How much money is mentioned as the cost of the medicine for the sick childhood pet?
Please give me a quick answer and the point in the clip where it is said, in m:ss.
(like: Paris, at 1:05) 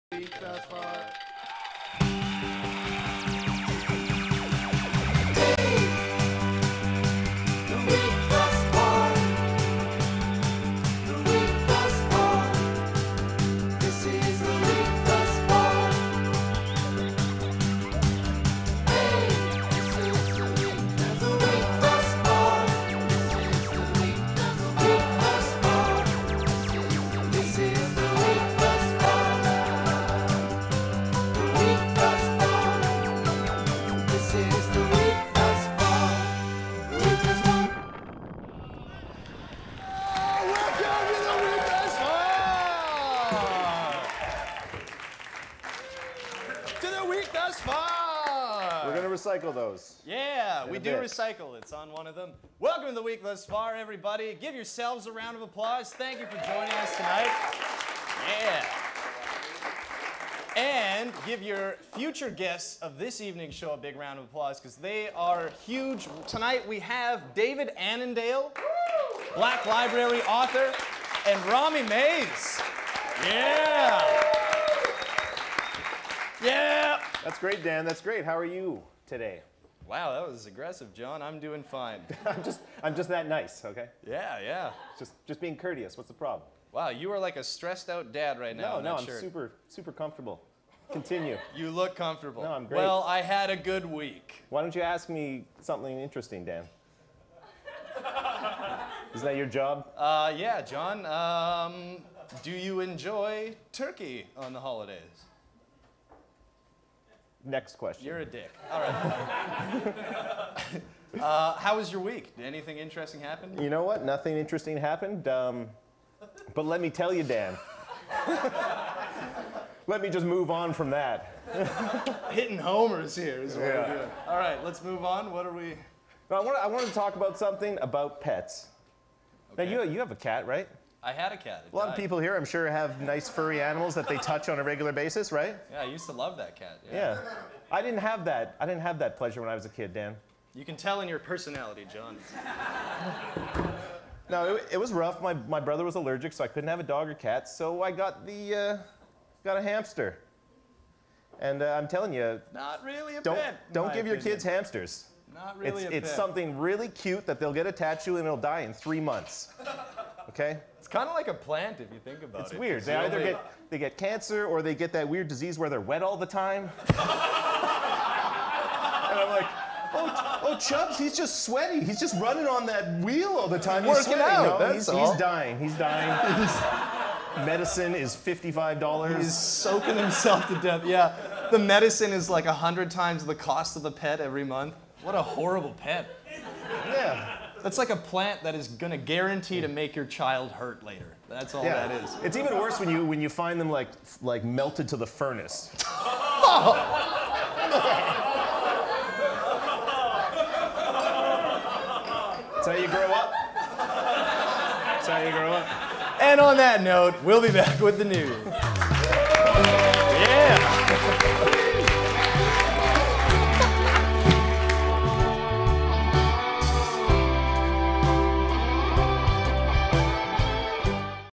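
$55, at 2:58.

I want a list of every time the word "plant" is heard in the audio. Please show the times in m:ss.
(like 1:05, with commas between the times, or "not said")
2:41, 3:07.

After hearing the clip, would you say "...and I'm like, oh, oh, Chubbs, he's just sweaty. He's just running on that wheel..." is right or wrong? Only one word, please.
right.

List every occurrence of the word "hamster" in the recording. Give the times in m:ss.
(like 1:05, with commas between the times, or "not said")
2:29, 2:34.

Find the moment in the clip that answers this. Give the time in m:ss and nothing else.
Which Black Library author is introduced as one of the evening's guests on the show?
1:07.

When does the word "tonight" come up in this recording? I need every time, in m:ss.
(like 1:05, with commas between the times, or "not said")
0:56, 1:06.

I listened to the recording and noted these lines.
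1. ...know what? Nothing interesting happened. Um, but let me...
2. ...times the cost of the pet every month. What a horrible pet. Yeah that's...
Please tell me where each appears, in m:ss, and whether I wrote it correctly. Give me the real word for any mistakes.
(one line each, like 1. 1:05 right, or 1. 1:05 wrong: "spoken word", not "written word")
1. 1:53 right
2. 3:02 right.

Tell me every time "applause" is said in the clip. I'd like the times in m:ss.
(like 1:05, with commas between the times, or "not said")
0:55, 1:04.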